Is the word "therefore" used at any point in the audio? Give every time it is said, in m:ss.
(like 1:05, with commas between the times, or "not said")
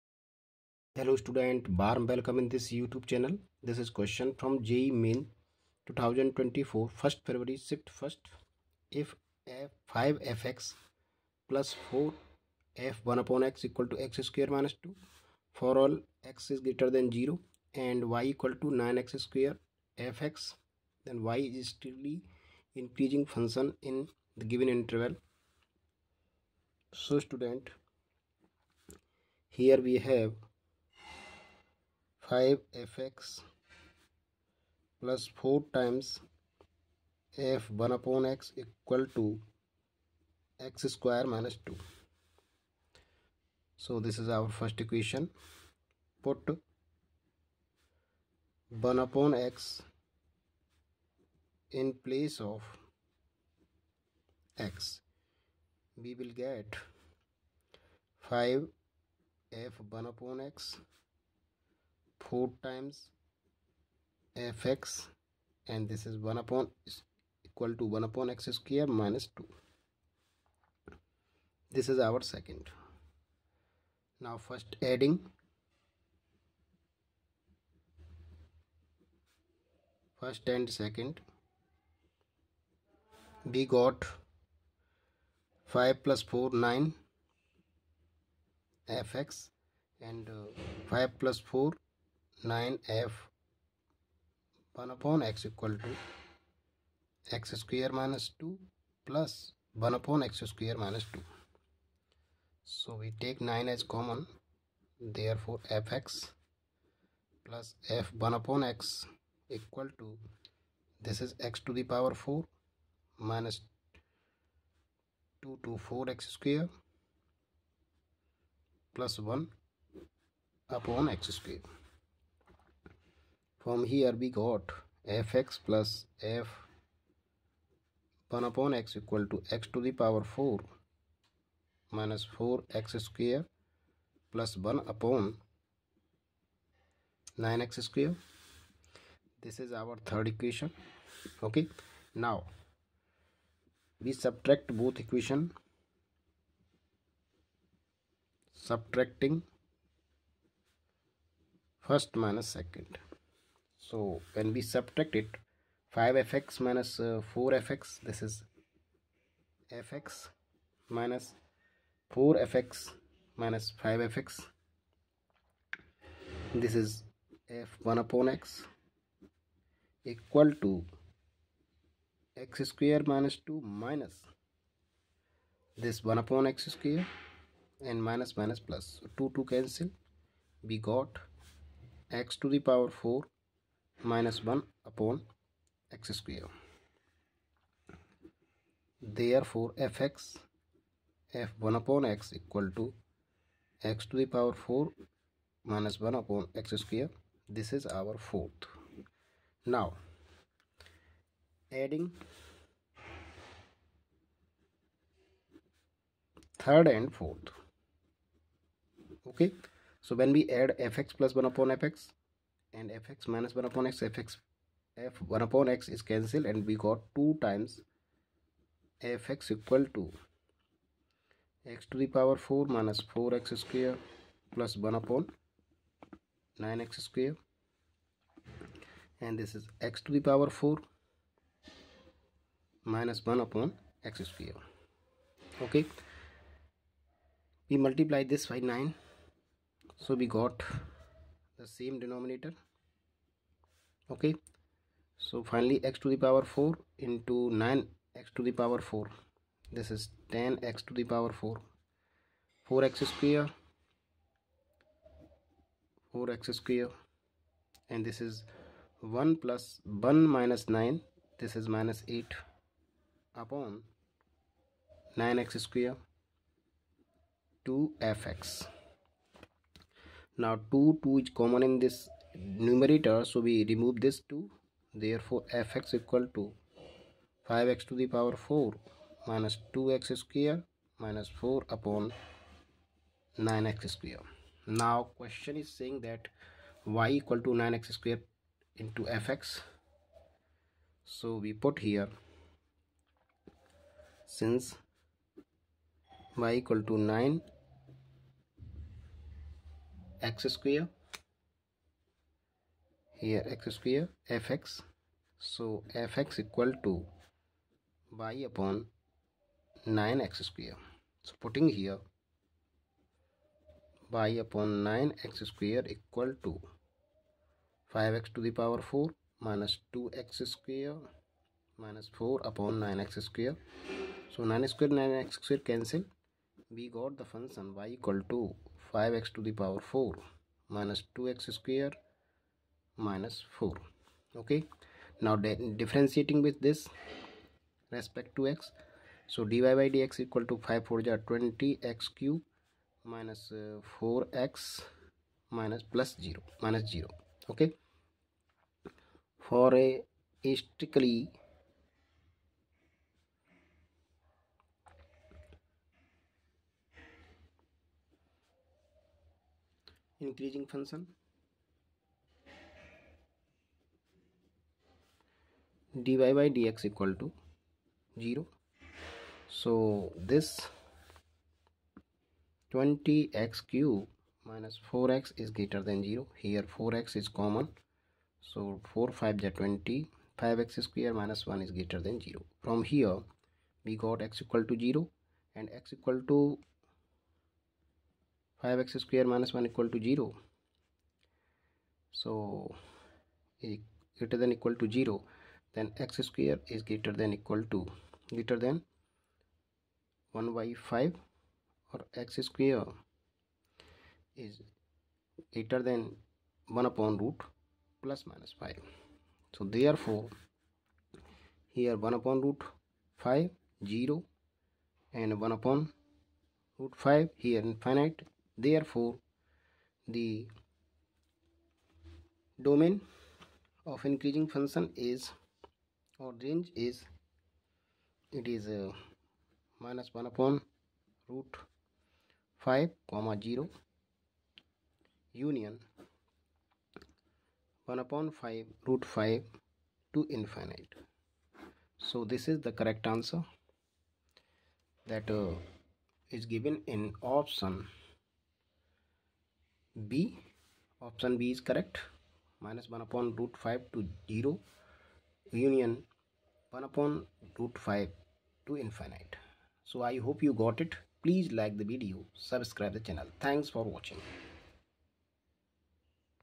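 1:44, 3:09, 4:35, 6:49, 6:58.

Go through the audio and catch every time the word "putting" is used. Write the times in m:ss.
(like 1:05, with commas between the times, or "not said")
5:11.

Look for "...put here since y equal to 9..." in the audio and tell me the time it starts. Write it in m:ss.
4:51.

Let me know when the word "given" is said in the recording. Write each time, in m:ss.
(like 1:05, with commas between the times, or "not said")
0:24, 7:26.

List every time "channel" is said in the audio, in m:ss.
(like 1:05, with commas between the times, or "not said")
0:03, 7:43.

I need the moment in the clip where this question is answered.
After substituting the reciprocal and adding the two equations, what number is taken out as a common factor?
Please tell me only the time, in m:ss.
1:42.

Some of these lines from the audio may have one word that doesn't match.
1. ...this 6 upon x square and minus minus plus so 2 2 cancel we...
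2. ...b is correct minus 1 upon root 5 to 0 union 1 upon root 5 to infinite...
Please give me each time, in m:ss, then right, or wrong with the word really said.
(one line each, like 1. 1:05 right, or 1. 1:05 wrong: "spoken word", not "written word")
1. 2:55 wrong: "1", not "6"
2. 7:31 right.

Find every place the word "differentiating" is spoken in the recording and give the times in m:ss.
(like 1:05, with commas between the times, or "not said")
5:35.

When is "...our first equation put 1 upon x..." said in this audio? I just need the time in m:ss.
0:44.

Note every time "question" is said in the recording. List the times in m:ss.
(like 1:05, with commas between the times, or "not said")
0:03, 4:45.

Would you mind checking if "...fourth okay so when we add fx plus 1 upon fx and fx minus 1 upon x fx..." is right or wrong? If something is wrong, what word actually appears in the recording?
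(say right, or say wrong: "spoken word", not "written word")
right.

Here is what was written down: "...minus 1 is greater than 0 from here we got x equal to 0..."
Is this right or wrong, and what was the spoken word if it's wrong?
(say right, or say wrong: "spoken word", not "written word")
right.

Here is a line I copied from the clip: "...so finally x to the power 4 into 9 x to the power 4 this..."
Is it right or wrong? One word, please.
right.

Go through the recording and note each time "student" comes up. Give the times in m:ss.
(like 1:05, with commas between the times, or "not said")
0:01, 0:27.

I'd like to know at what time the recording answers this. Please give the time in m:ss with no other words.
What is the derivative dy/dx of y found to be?
5:41.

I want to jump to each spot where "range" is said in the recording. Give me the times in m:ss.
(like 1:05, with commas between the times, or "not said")
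7:06.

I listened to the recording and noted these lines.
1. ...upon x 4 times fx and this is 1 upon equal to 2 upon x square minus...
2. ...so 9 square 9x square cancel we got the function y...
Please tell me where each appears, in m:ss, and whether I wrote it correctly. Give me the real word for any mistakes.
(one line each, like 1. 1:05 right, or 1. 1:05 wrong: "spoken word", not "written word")
1. 1:00 wrong: "1", not "2"
2. 5:24 right.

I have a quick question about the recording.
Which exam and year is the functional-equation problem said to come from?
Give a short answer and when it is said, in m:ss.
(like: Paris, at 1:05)
JEE Main 2024, at 0:04.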